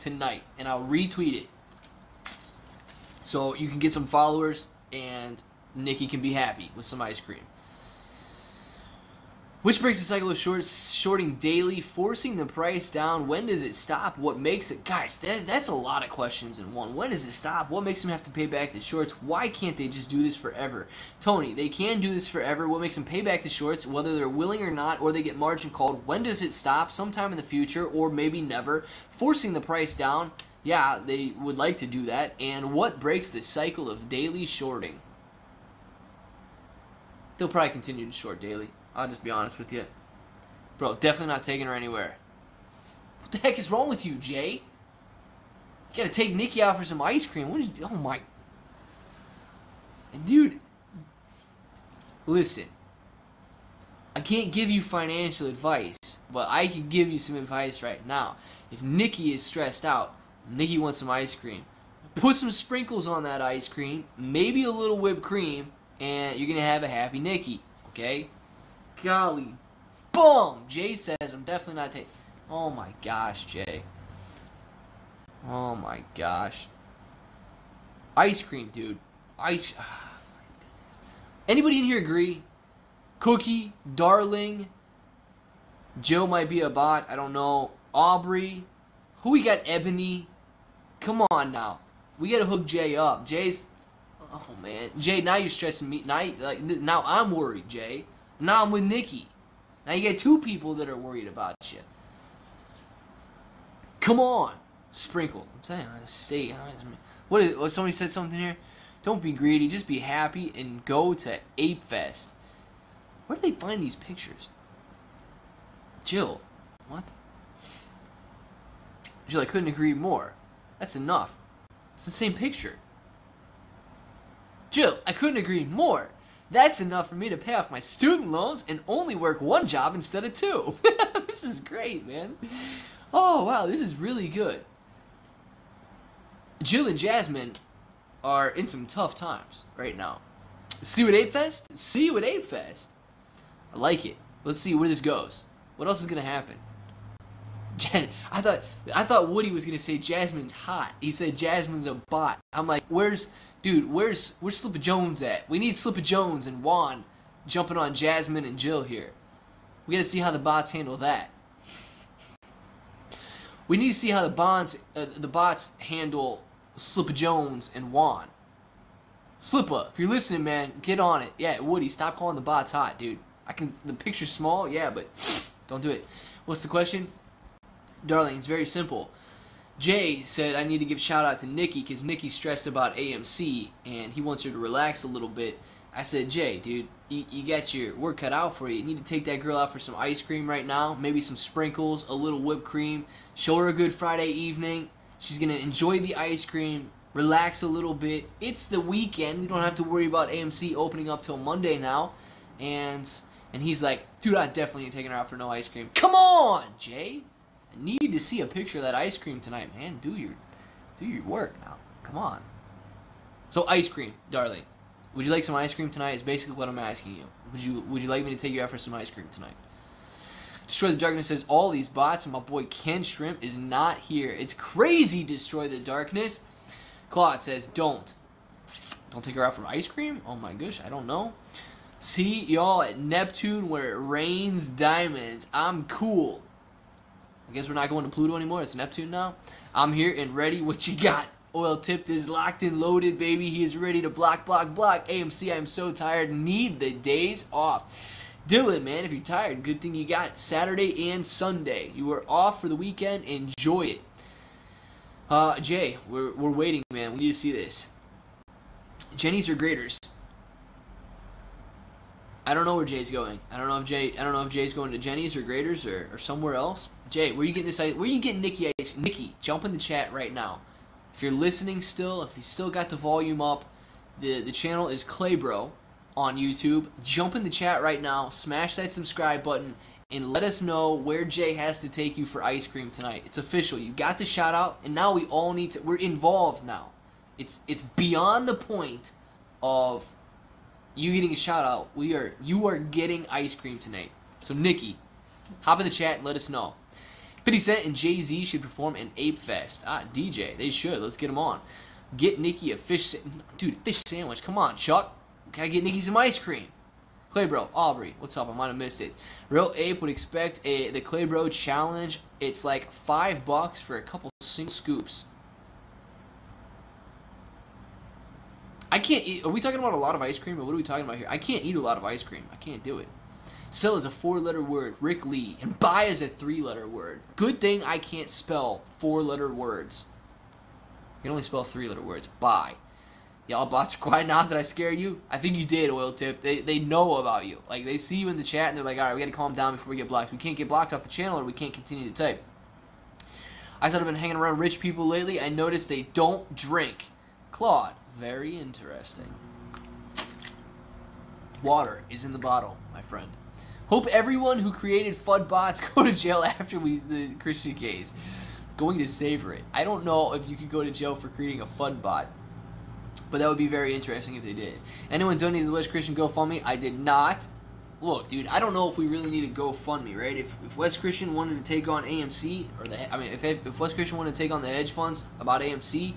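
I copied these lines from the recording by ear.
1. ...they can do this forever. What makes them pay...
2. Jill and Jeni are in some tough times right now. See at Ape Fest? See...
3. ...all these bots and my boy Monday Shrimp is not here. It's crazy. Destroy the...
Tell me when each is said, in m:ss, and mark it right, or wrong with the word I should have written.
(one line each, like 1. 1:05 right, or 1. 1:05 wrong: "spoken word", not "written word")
1. 0:21 right
2. 2:16 wrong: "Jasmine", not "Jeni"
3. 3:41 wrong: "Ken", not "Monday".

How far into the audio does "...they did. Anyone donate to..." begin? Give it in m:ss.
6:04.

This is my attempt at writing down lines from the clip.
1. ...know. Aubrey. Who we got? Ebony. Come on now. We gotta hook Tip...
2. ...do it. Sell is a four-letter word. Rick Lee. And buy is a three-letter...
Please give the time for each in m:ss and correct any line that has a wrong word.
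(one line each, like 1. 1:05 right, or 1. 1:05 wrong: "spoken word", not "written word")
1. 1:27 wrong: "Jay", not "Tip"
2. 5:22 right.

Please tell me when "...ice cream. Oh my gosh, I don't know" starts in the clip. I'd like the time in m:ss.
3:49.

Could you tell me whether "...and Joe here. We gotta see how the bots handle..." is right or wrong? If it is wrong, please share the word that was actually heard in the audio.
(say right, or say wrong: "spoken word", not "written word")
wrong: "Jill", not "Joe".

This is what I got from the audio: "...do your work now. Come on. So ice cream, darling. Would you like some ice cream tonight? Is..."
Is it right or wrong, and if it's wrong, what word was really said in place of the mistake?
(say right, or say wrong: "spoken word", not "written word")
right.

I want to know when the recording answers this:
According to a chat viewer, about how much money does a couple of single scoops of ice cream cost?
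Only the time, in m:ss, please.
5:12.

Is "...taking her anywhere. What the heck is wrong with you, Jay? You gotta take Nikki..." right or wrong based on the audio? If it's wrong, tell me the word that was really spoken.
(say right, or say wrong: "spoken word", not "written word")
right.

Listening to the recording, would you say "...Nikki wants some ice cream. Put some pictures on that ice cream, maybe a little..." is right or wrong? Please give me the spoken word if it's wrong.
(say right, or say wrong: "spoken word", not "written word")
wrong: "sprinkles", not "pictures".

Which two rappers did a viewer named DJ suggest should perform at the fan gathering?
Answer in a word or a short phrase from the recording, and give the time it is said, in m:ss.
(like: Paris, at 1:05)
50 Cent and Jay Z, at 4:57.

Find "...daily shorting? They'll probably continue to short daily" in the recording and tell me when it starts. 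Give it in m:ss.
0:34.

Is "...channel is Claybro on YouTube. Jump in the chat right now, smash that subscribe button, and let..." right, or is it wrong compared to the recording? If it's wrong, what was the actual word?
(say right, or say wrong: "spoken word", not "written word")
right.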